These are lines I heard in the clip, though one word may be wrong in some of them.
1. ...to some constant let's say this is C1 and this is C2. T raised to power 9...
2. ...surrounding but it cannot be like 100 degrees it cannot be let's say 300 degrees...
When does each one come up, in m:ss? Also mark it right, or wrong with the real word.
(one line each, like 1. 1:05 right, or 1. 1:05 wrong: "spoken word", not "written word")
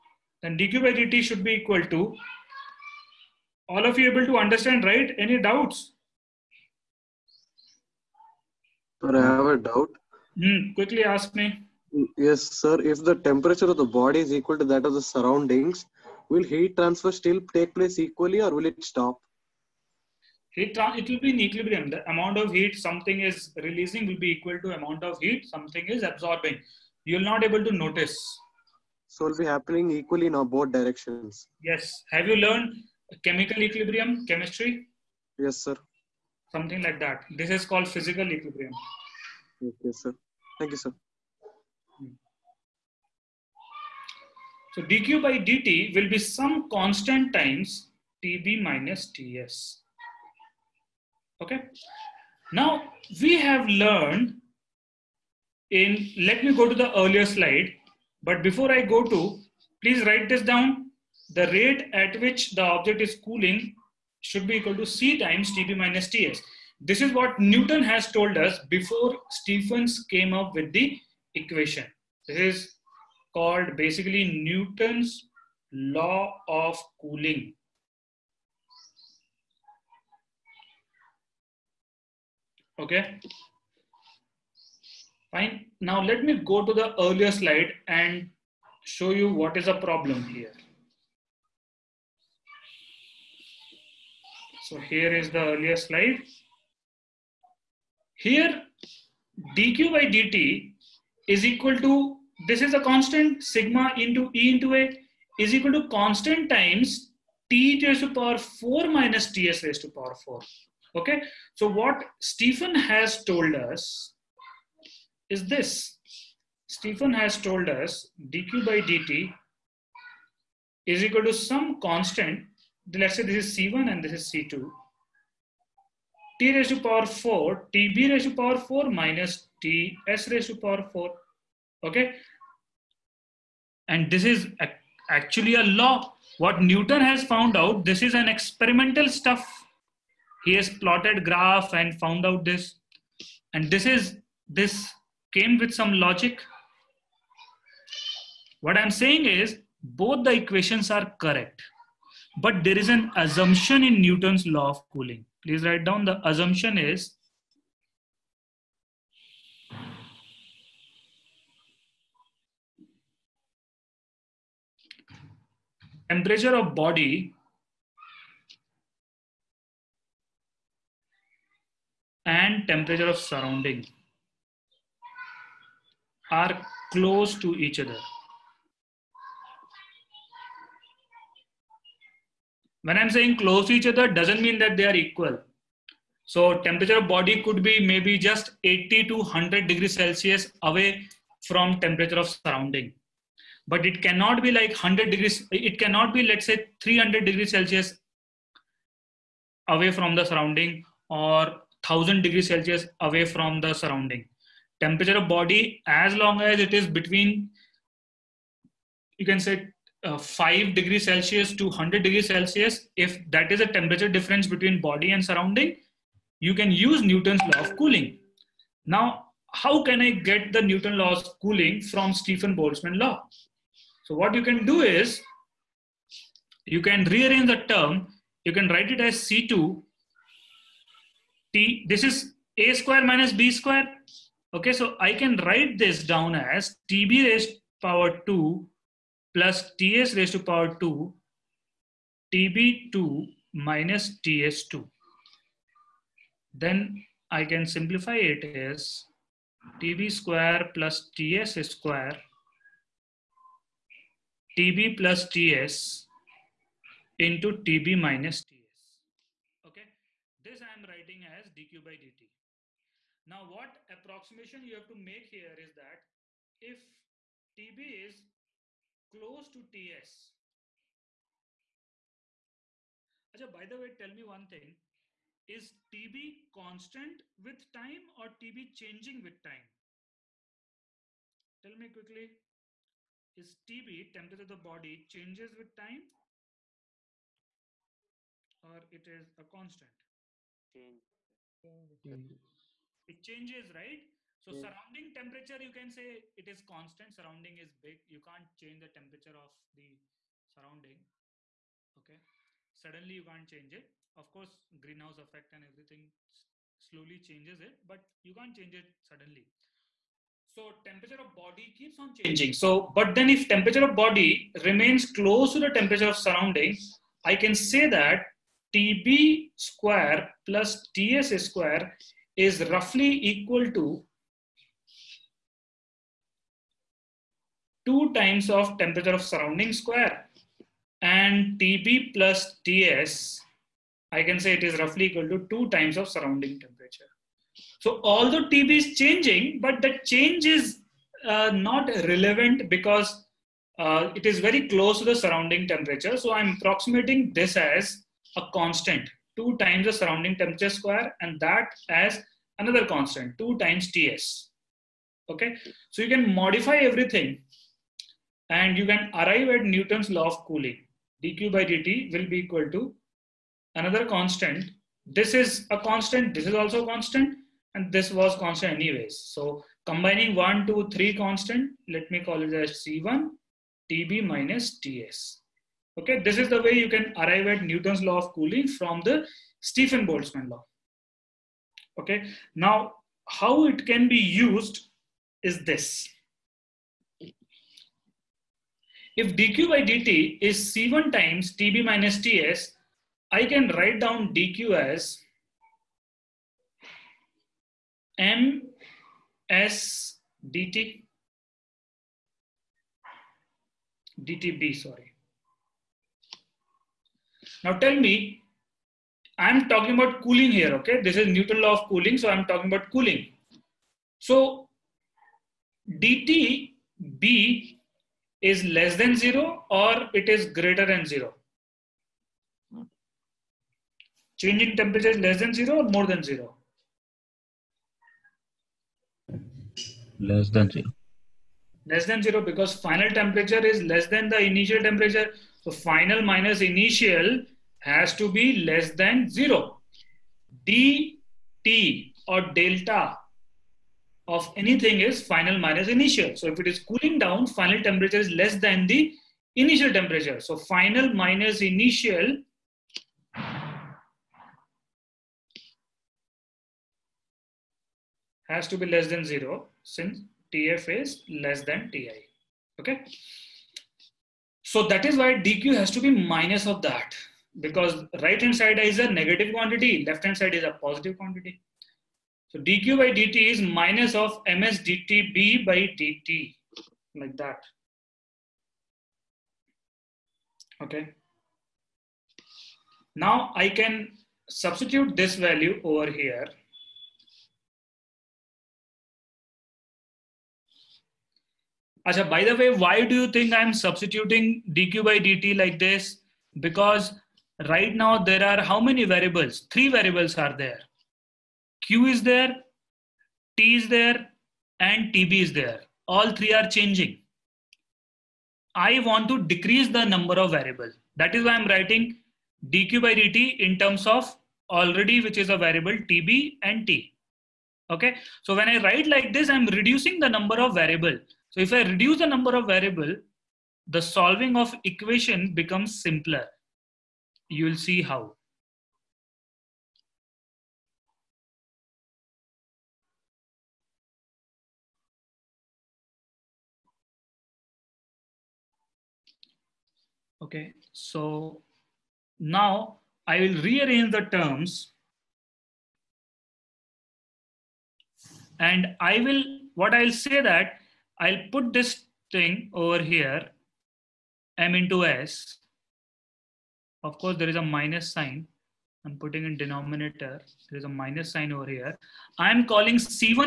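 1. 2:01 wrong: "4", not "9"
2. 3:12 right.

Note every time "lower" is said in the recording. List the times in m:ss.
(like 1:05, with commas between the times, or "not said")
not said.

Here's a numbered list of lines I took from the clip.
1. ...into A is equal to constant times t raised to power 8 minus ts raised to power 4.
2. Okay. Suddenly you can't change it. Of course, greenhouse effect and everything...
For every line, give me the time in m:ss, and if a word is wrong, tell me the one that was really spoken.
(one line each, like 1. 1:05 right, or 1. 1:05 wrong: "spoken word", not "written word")
1. 1:44 wrong: "4", not "8"
2. 5:01 right.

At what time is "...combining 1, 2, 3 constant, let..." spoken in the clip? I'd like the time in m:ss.
6:09.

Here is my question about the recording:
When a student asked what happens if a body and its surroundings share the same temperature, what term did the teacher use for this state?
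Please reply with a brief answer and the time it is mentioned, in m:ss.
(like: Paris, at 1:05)
Physical equilibrium, at 0:37.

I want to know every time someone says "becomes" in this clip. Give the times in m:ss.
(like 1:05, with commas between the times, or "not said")
8:45.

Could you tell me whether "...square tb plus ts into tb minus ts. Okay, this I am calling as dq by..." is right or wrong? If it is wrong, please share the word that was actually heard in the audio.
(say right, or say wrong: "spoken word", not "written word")
wrong: "writing", not "calling".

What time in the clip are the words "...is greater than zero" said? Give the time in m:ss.
7:00.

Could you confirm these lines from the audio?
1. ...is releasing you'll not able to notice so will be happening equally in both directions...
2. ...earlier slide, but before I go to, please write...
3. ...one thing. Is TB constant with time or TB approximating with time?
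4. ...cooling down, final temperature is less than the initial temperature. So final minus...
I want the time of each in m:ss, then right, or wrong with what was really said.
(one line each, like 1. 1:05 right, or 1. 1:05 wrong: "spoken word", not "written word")
1. 0:25 wrong: "absorbing", not "releasing"
2. 0:56 right
3. 4:34 wrong: "changing", not "approximating"
4. 7:26 right.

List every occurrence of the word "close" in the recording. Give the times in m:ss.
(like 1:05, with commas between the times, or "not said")
2:56, 3:03, 4:29, 5:15, 5:44.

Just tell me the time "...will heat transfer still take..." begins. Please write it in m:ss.
0:16.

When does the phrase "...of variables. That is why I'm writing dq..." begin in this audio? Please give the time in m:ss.
8:30.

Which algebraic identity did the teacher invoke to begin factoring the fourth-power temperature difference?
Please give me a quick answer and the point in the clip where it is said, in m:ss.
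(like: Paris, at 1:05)
A square minus B square, at 3:52.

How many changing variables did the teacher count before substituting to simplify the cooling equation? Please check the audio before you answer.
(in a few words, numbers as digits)
3.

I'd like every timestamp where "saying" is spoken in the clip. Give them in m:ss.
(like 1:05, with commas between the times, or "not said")
2:28, 3:03.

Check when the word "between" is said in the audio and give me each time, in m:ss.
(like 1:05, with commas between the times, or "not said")
3:26, 3:34.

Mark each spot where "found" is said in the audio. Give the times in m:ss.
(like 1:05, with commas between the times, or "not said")
2:17, 2:21.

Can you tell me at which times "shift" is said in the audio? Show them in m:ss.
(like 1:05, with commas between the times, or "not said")
not said.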